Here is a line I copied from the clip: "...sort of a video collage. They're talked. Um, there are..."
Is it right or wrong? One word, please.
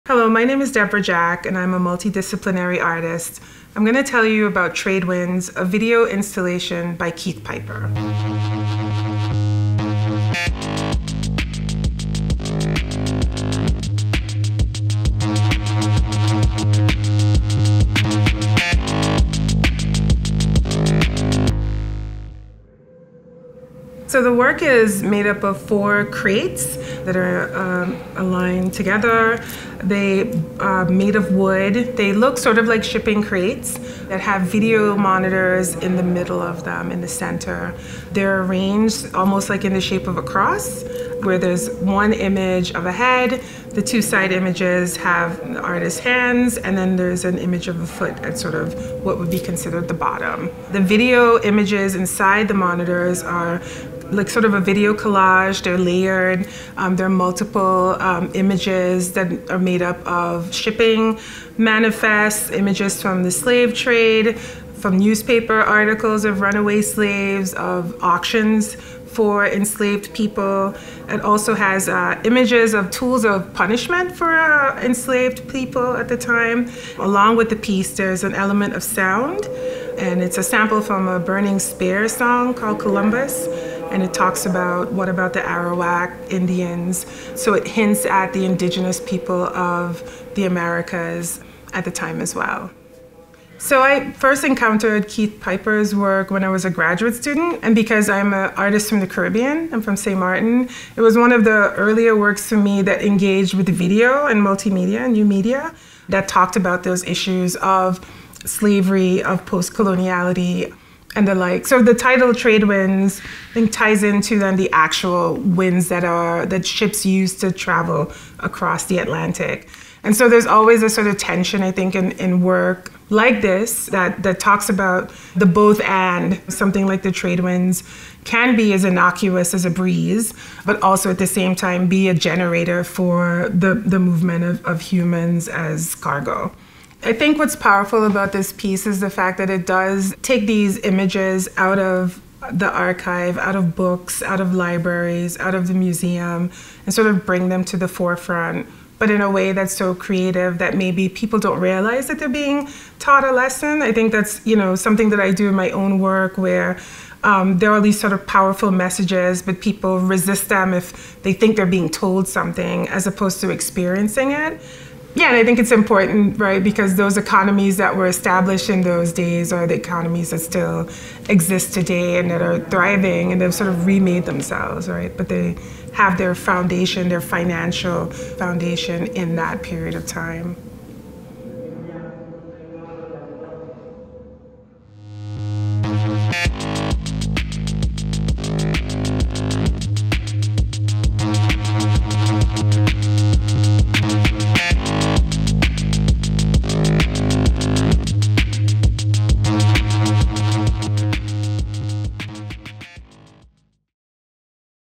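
wrong.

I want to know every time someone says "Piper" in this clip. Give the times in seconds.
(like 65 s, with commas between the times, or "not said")
7 s, 95 s.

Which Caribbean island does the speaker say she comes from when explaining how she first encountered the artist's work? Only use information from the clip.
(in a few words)
St. Martin.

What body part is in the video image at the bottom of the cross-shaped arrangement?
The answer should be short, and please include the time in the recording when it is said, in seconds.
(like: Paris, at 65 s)
Foot, at 47 s.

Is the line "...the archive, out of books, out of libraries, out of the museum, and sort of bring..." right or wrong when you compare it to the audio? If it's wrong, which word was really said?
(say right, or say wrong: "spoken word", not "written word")
right.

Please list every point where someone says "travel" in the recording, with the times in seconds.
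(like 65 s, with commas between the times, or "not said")
117 s.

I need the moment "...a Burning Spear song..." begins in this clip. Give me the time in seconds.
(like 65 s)
81 s.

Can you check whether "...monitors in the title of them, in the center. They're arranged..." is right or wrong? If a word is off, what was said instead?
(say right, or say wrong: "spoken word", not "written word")
wrong: "middle", not "title".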